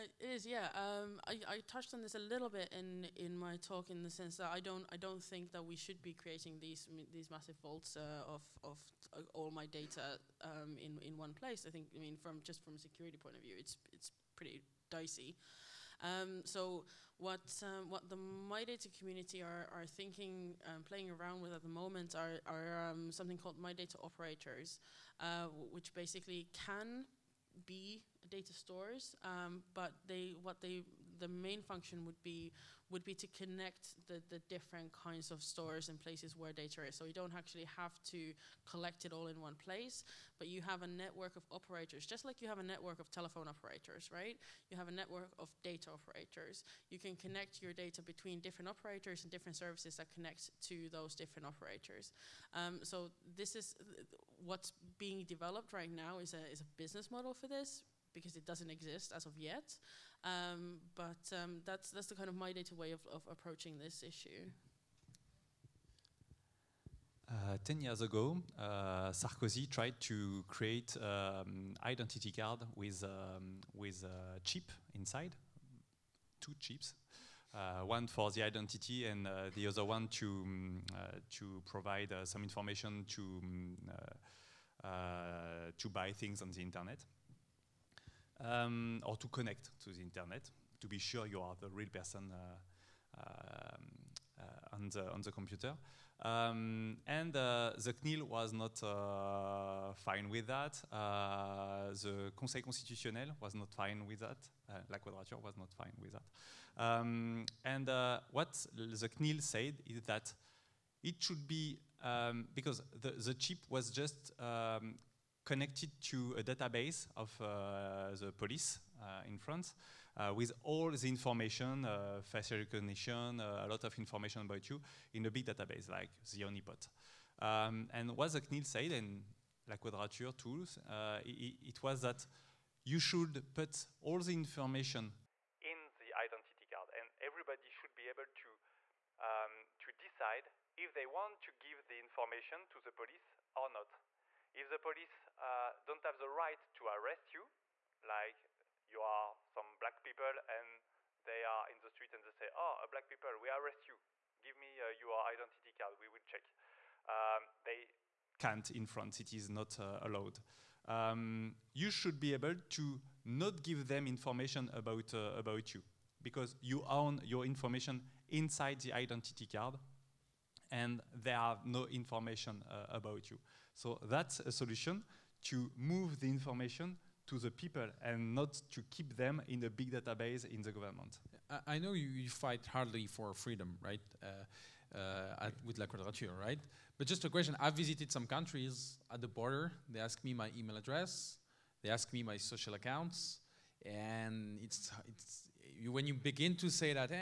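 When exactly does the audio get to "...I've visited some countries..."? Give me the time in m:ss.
3:07.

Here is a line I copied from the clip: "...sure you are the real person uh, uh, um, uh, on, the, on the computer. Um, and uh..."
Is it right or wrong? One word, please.
right.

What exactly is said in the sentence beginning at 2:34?
Give me uh, your identity card, we will check.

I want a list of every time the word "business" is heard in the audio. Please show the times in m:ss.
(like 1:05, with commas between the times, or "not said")
0:56.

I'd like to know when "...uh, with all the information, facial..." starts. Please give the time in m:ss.
2:00.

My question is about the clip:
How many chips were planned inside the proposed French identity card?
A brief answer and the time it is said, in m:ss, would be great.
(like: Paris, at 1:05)
2, at 1:16.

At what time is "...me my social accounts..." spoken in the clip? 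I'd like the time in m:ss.
3:12.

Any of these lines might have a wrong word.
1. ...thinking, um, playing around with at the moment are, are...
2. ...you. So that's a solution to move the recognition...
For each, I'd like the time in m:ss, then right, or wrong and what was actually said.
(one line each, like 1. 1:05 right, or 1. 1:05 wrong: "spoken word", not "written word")
1. 0:19 right
2. 2:53 wrong: "information", not "recognition".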